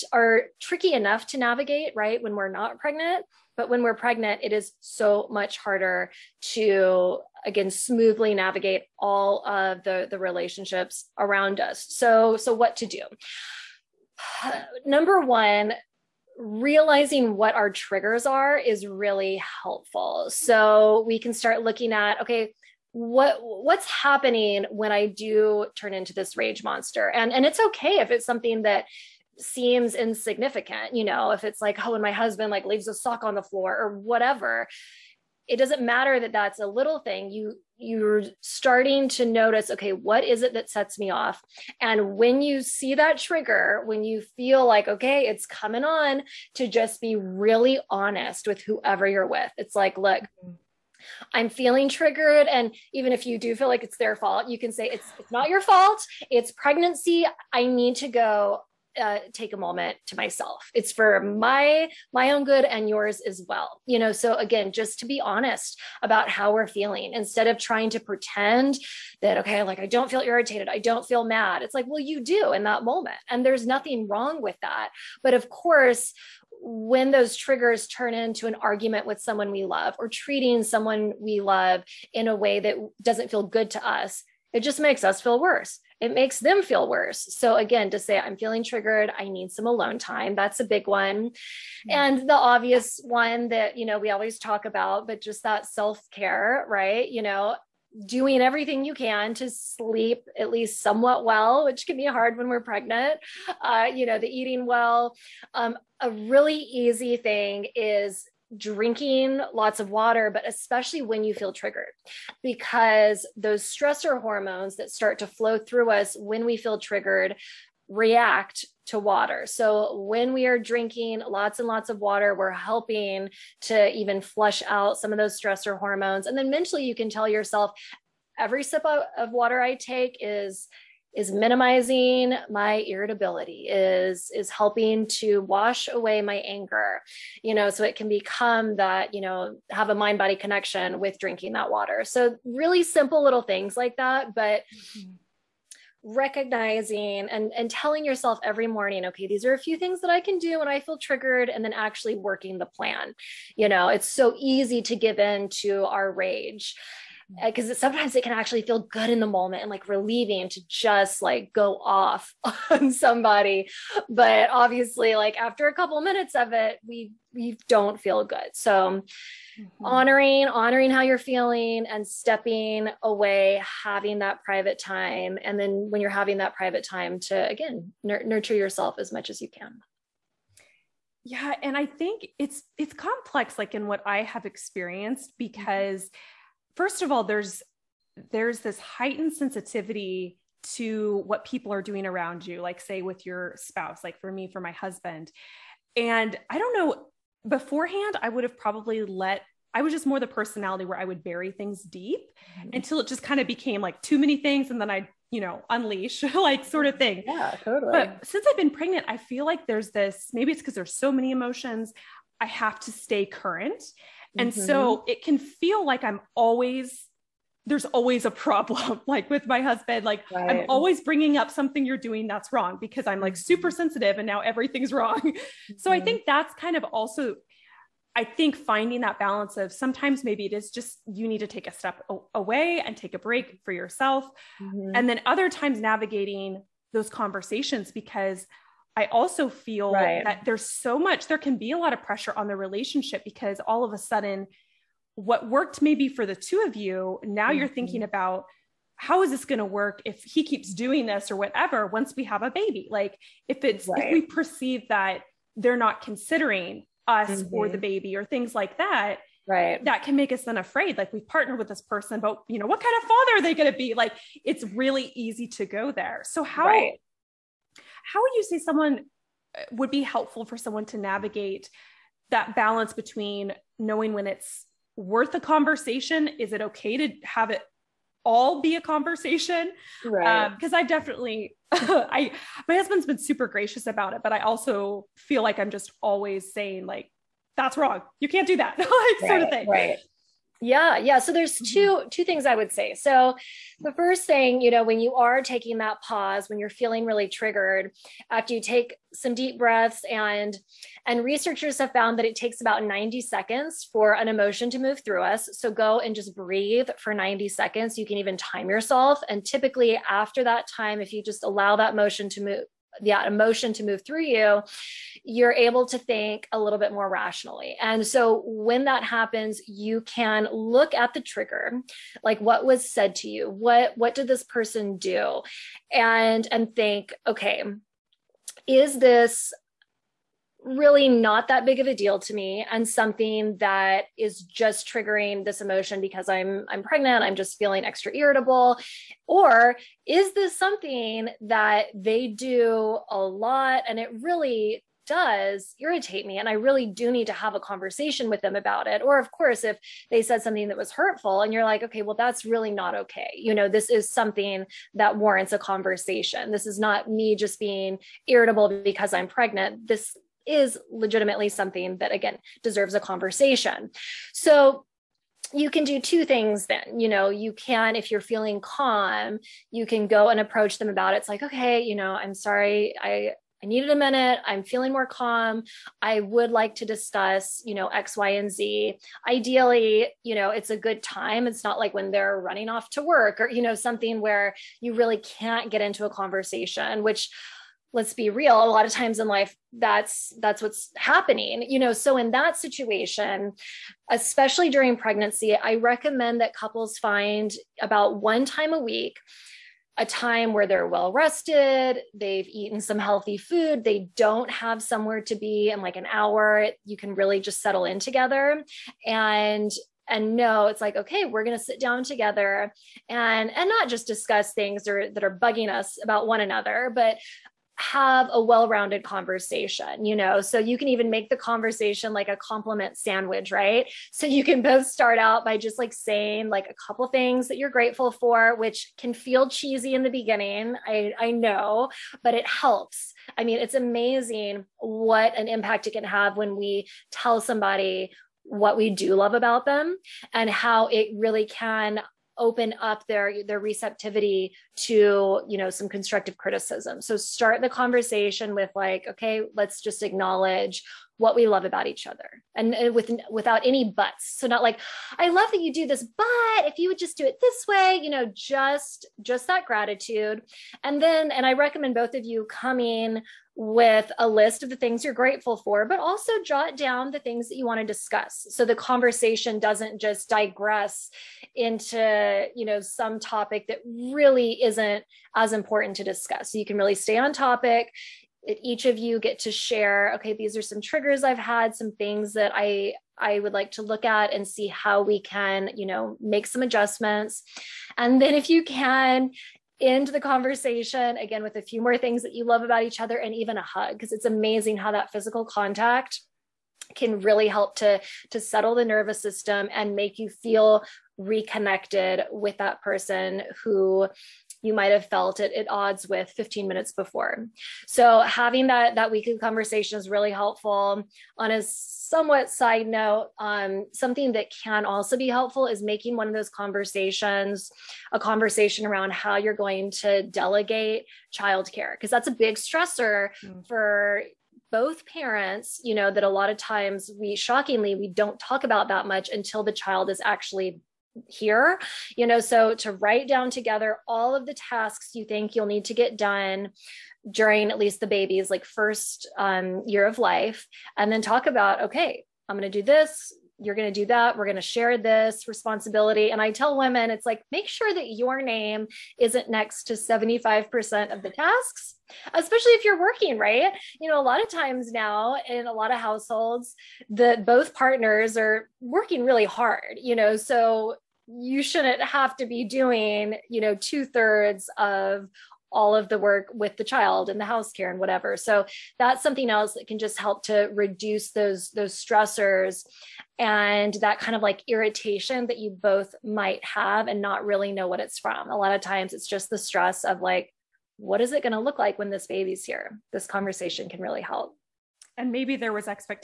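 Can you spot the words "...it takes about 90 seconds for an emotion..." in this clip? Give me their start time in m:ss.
5:02.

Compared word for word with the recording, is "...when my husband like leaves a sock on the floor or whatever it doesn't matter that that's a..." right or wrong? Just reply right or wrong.
right.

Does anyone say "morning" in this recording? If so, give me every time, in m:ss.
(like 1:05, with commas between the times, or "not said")
2:28.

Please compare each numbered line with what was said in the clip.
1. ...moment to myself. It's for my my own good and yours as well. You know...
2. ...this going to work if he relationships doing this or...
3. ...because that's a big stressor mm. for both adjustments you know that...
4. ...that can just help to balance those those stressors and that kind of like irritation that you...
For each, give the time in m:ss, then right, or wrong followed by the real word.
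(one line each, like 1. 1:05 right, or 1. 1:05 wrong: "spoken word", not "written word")
1. 0:59 right
2. 4:09 wrong: "keeps", not "relationships"
3. 8:41 wrong: "parents", not "adjustments"
4. 9:29 wrong: "reduce", not "balance".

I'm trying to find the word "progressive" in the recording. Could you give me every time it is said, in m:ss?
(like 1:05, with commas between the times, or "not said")
not said.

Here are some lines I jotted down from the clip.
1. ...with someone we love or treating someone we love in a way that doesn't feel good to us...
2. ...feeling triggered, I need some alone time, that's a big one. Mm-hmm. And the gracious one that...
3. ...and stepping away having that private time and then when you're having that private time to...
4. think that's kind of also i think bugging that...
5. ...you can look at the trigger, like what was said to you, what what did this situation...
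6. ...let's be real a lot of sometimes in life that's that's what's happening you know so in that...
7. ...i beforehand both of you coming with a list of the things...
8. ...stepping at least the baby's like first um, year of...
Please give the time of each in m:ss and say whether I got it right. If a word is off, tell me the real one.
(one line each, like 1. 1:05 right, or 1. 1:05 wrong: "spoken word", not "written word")
1. 1:19 right
2. 1:28 wrong: "obvious", not "gracious"
3. 2:51 right
4. 3:46 wrong: "finding", not "bugging"
5. 5:19 wrong: "person", not "situation"
6. 6:27 wrong: "times", not "sometimes"
7. 7:41 wrong: "recommend", not "beforehand"
8. 8:57 wrong: "during", not "stepping".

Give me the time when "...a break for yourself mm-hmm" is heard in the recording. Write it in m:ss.
3:53.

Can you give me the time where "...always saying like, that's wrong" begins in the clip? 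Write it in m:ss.
4:46.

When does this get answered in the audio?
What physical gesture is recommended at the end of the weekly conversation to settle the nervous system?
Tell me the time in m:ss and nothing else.
8:13.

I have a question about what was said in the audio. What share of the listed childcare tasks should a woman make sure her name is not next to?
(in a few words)
75%.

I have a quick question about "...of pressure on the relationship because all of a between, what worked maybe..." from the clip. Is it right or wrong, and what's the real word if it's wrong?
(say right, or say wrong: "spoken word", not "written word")
wrong: "sudden", not "between".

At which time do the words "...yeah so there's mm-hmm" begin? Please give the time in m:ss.
4:50.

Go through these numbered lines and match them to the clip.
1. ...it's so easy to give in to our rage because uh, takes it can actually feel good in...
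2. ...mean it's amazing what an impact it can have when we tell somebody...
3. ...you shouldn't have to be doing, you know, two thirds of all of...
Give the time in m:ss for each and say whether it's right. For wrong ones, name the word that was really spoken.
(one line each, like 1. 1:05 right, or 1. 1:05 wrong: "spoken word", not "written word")
1. 2:33 wrong: "sometimes", not "takes"
2. 7:13 right
3. 9:21 right.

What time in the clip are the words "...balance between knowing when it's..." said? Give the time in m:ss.
4:32.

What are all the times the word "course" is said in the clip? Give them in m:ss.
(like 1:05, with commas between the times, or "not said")
1:15, 5:49.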